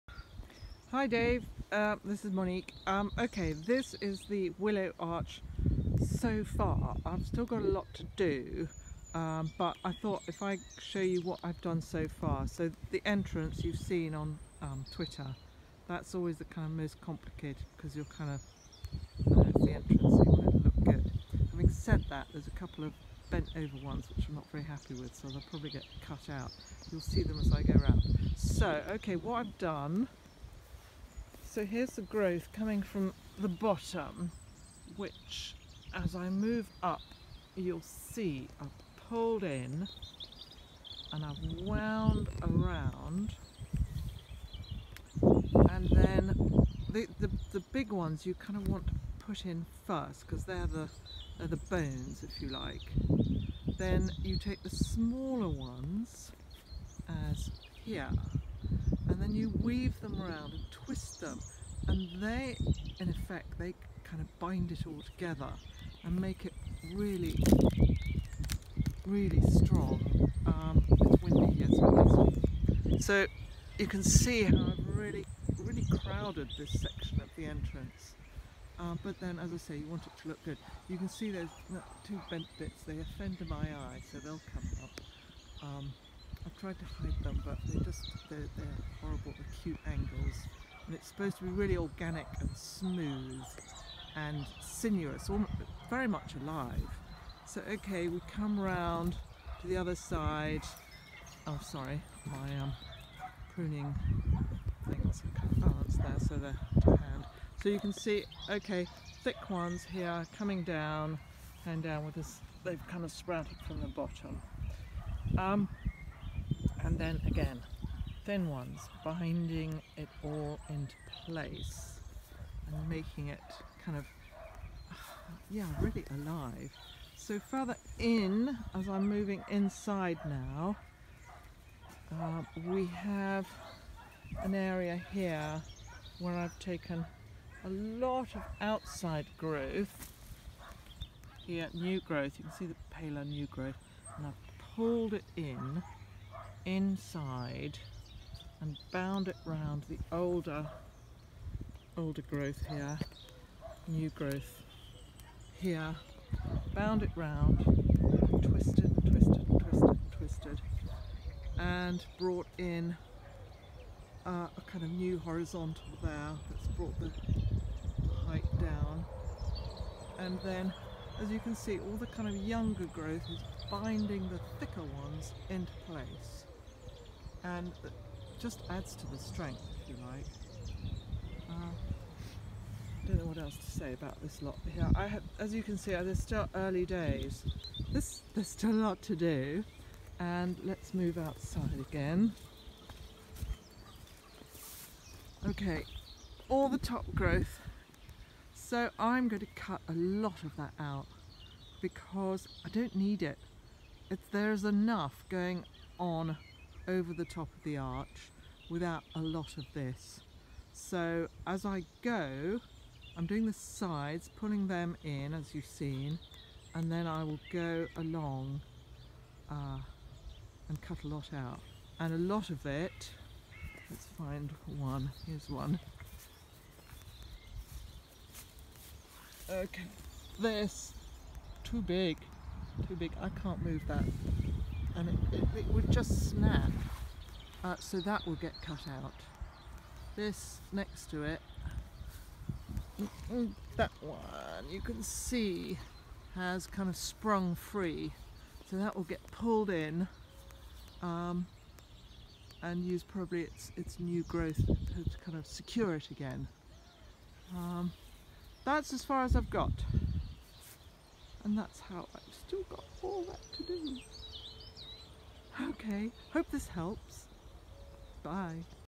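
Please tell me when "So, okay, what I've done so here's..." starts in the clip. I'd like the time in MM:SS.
00:28.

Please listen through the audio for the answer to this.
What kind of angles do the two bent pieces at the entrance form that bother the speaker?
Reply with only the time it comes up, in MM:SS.
01:29.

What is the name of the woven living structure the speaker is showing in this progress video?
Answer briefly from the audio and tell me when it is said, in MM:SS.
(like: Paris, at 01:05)
Willow Arch, at 00:04.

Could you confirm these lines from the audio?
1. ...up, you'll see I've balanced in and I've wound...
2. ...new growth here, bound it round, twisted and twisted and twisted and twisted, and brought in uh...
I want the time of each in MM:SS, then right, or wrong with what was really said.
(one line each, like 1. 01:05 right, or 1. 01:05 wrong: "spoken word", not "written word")
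1. 00:36 wrong: "pulled", not "balanced"
2. 02:33 right.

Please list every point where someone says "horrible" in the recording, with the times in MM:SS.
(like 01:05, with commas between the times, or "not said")
01:29.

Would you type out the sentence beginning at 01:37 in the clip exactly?
So okay, we come round to the other side.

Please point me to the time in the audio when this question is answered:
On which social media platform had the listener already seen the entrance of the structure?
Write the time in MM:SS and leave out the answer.
00:14.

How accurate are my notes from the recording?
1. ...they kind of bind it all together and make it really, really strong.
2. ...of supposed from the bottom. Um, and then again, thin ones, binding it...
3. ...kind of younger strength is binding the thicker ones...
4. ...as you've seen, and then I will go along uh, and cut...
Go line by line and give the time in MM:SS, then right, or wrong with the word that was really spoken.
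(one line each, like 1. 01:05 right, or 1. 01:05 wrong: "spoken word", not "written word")
1. 01:03 right
2. 01:53 wrong: "sprouted", not "supposed"
3. 02:52 wrong: "growth", not "strength"
4. 03:35 right.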